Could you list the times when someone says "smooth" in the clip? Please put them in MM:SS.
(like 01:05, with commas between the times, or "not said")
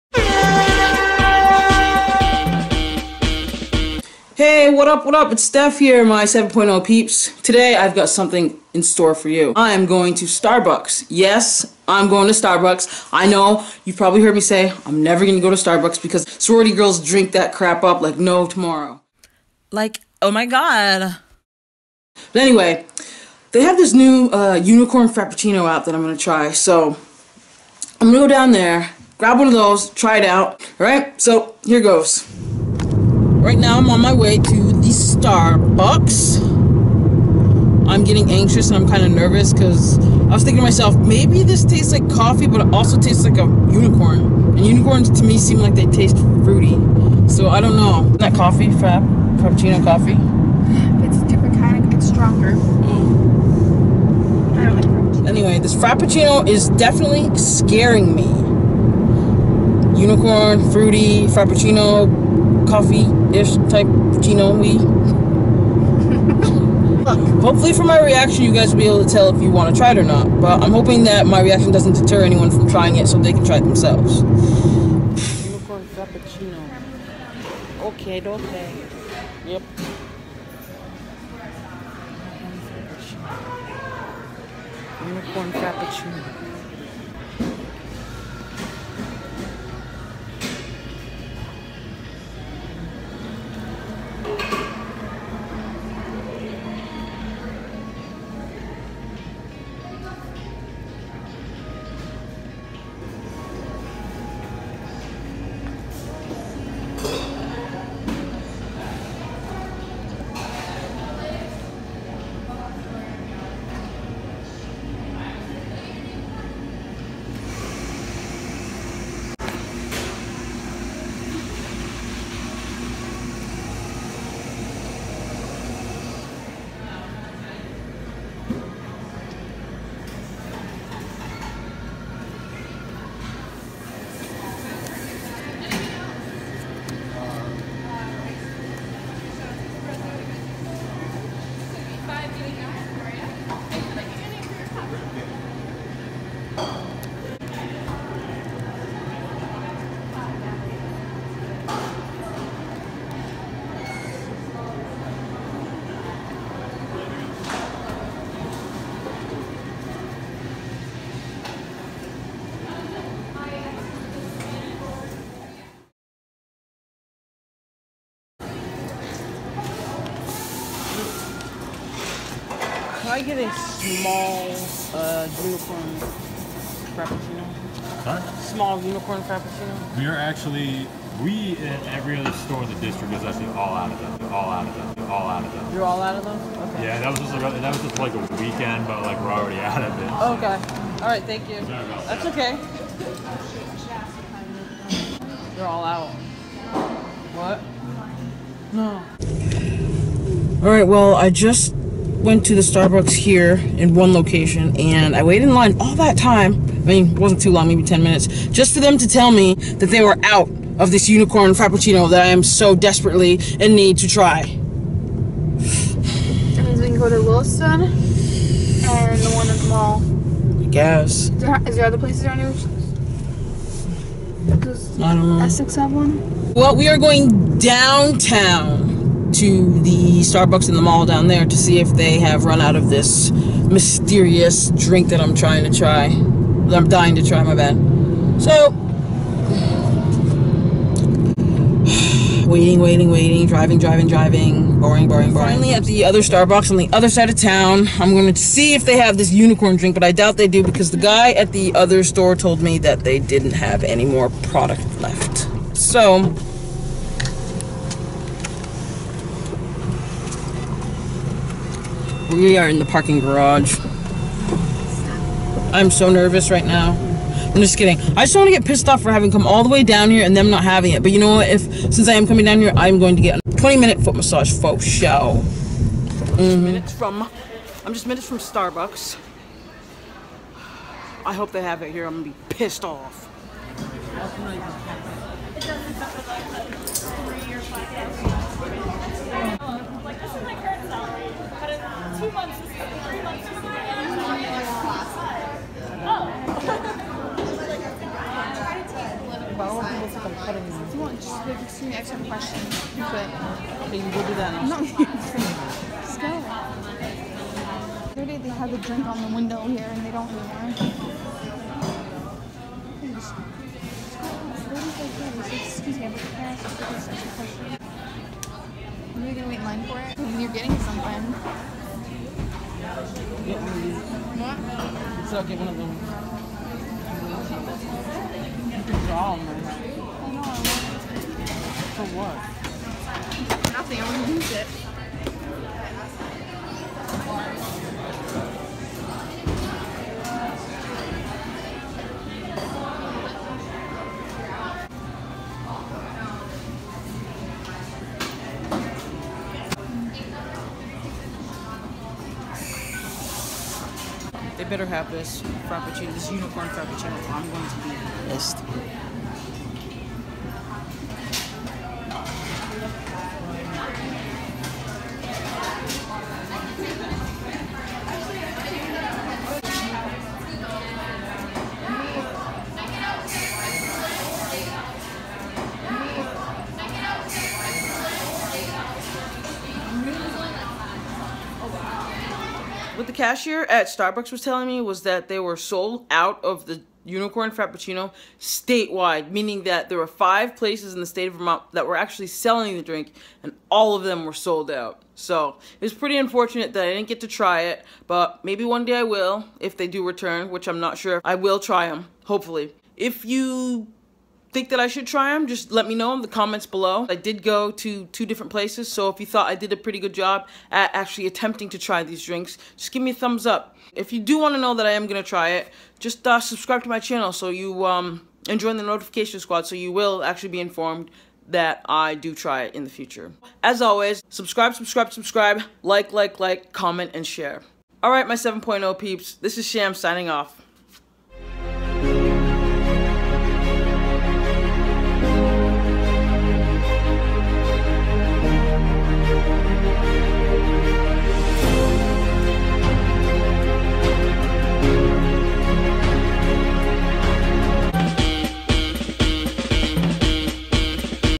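not said.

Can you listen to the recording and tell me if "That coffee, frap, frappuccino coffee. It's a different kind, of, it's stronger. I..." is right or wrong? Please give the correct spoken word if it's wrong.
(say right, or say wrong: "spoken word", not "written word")
right.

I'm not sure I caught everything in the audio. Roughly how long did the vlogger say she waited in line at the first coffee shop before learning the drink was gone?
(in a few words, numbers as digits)
10 minutes.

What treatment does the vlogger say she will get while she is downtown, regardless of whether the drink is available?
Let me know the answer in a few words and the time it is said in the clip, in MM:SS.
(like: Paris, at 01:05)
foot massage, at 04:33.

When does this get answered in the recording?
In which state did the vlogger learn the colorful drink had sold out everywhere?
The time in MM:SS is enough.
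06:31.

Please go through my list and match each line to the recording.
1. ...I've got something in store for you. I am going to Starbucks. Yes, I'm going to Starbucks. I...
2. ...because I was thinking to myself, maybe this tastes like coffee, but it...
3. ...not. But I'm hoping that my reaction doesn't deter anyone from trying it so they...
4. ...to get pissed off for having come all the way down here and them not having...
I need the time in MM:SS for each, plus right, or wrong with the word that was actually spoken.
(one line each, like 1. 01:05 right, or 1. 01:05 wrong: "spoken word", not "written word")
1. 00:07 right
2. 00:39 right
3. 01:10 right
4. 04:28 right.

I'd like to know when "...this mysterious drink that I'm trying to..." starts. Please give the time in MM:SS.
03:52.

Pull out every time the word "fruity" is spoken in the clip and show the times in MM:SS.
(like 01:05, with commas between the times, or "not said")
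00:46, 01:00.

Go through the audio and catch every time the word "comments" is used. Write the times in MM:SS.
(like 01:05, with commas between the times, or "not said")
06:46, 07:06.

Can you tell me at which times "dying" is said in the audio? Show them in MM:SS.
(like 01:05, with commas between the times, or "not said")
03:56.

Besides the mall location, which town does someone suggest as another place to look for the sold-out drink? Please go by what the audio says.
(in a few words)
Williston.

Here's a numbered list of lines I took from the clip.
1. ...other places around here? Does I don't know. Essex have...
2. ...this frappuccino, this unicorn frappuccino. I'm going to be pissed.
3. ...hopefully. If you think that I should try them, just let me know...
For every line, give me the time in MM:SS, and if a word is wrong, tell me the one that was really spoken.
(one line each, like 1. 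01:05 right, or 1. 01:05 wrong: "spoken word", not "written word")
1. 03:41 right
2. 05:55 right
3. 06:42 right.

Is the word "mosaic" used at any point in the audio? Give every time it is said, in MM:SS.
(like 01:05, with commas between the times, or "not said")
not said.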